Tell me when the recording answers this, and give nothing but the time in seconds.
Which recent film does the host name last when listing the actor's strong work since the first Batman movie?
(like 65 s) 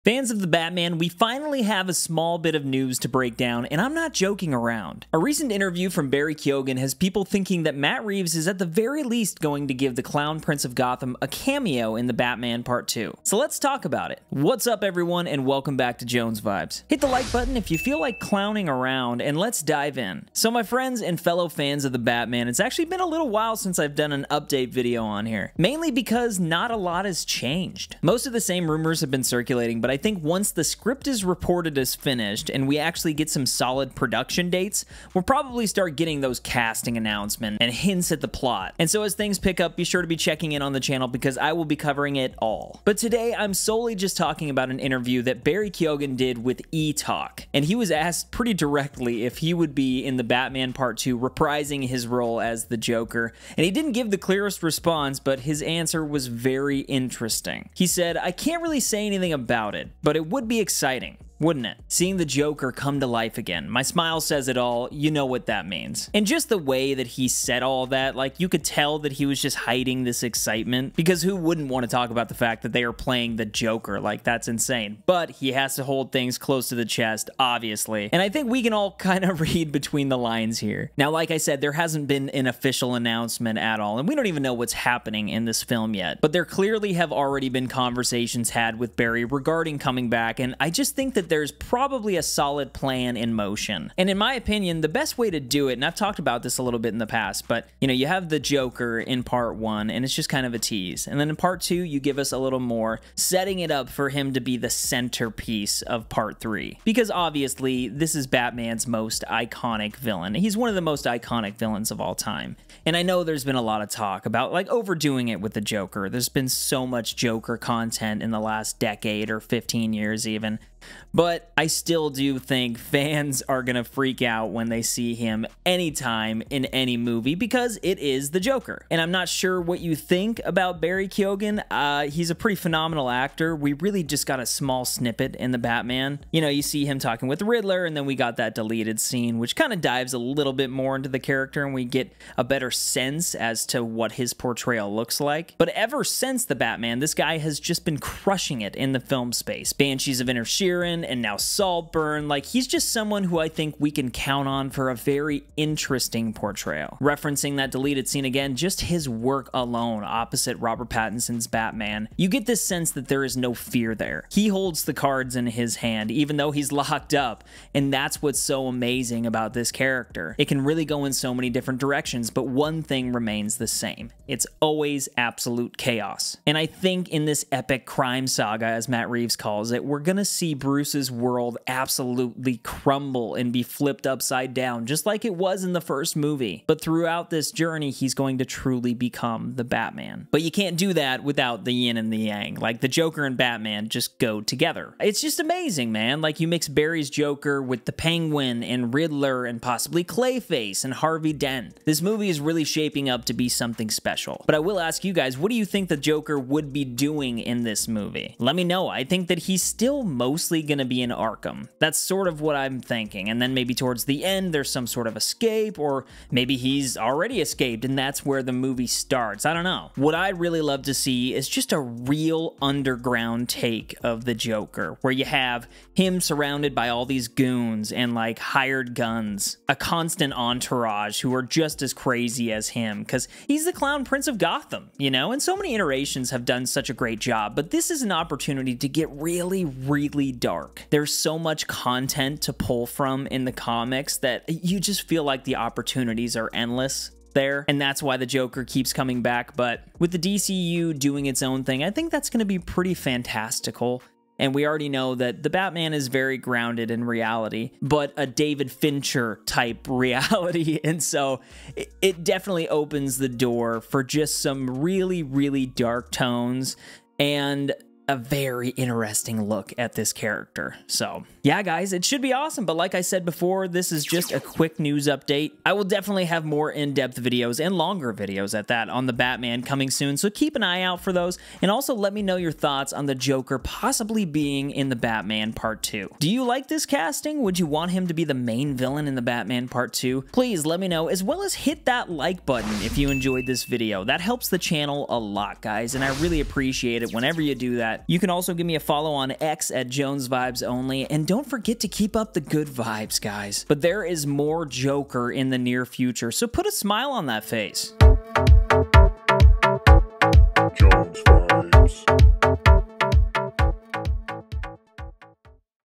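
151 s.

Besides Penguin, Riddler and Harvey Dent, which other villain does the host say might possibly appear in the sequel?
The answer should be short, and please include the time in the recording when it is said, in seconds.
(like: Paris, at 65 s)
Clayface, at 200 s.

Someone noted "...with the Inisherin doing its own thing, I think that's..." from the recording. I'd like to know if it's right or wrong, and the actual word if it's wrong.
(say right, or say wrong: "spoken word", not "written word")
wrong: "DCU", not "Inisherin".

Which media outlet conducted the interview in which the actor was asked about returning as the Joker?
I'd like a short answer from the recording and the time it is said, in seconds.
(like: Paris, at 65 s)
E-Talk, at 46 s.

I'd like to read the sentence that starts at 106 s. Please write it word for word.
Because obviously, this is Batman's most iconic villain.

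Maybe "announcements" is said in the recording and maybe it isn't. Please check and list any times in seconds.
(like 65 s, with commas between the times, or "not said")
36 s, 82 s.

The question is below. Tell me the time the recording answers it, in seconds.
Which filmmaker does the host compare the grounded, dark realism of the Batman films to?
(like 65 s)
258 s.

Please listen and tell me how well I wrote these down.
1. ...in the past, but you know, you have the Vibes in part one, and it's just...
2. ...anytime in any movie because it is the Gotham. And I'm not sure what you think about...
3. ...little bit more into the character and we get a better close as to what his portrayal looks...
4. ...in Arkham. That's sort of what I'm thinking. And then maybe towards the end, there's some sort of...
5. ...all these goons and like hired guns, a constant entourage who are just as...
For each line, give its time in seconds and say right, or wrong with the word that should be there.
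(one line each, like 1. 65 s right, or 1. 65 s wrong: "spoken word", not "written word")
1. 96 s wrong: "Joker", not "Vibes"
2. 125 s wrong: "Joker", not "Gotham"
3. 140 s wrong: "sense", not "close"
4. 211 s right
5. 226 s right.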